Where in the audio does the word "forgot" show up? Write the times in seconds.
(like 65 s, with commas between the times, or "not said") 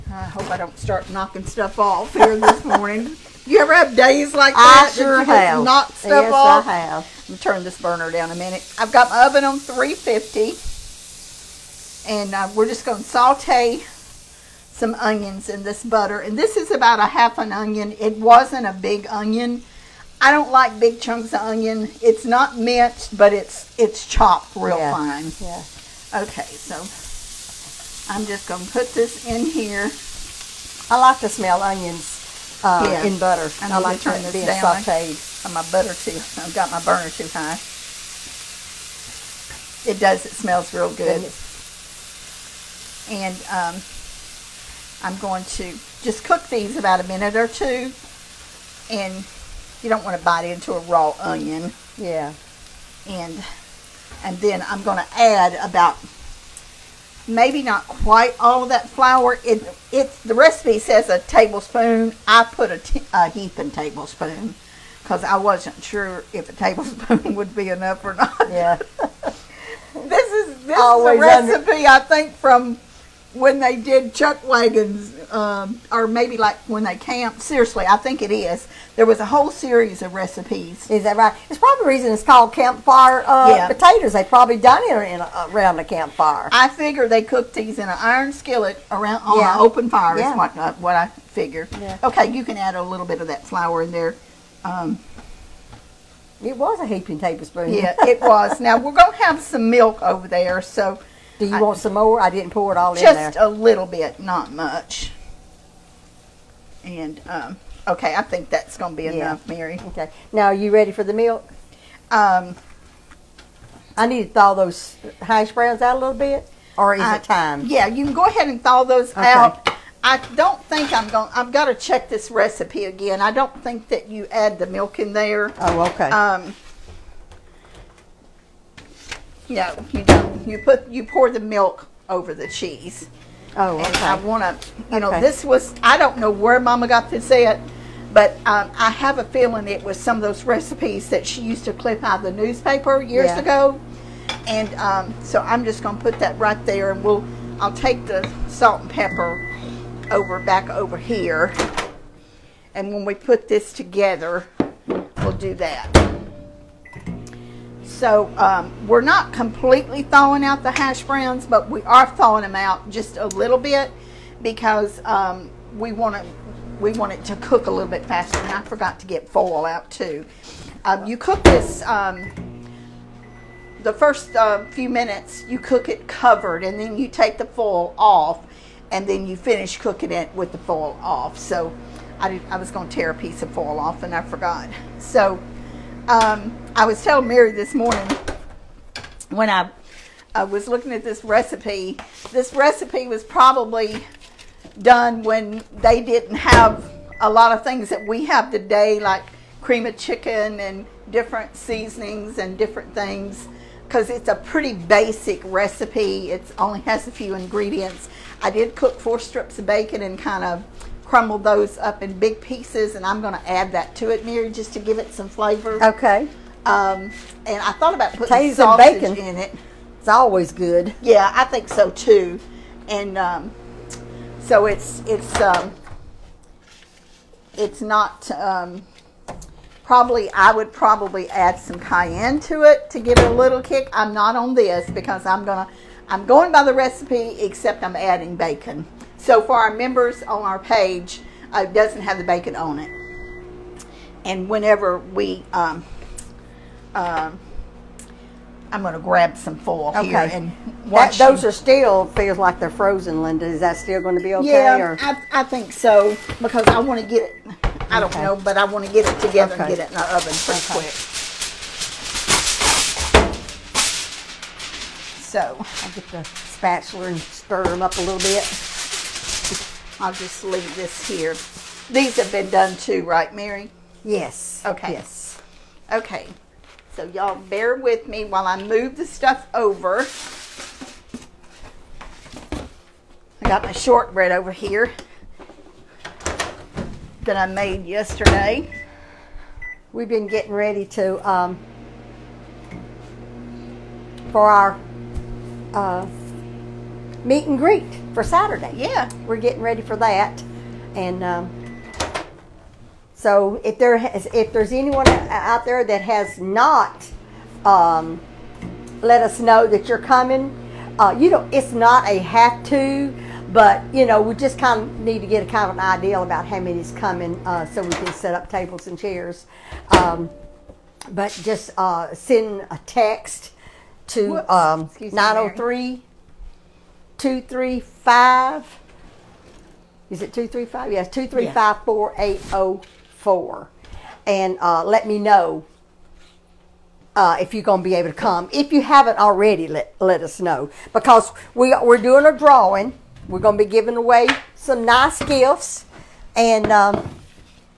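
168 s, 184 s.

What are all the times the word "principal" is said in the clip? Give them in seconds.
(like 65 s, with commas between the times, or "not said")
not said.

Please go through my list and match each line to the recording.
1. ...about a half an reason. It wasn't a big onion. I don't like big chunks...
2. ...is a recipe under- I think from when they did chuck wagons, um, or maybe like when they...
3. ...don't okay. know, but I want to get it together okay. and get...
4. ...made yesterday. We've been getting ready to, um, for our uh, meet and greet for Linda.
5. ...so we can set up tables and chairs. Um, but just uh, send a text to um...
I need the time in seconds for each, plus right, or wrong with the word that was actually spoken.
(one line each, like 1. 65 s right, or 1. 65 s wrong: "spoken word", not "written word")
1. 16 s wrong: "onion", not "reason"
2. 71 s right
3. 257 s right
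4. 287 s wrong: "Saturday", not "Linda"
5. 317 s right.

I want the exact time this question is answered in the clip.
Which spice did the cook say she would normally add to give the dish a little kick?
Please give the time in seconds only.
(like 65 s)
231 s.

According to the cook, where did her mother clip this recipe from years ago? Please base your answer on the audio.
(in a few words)
the newspaper.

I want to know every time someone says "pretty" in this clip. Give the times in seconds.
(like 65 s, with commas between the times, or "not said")
204 s, 260 s.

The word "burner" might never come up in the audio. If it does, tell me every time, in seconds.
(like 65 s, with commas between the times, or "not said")
7 s, 36 s.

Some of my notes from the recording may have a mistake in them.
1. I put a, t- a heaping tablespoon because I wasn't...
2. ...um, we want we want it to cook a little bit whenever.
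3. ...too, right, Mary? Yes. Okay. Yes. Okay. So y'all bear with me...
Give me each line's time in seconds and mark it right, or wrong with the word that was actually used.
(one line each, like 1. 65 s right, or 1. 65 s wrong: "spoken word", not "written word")
1. 62 s right
2. 165 s wrong: "faster", not "whenever"
3. 272 s right.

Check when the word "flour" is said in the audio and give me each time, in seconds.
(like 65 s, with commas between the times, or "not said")
58 s, 93 s.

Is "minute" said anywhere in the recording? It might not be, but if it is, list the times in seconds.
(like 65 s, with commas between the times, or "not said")
8 s, 47 s, 174 s.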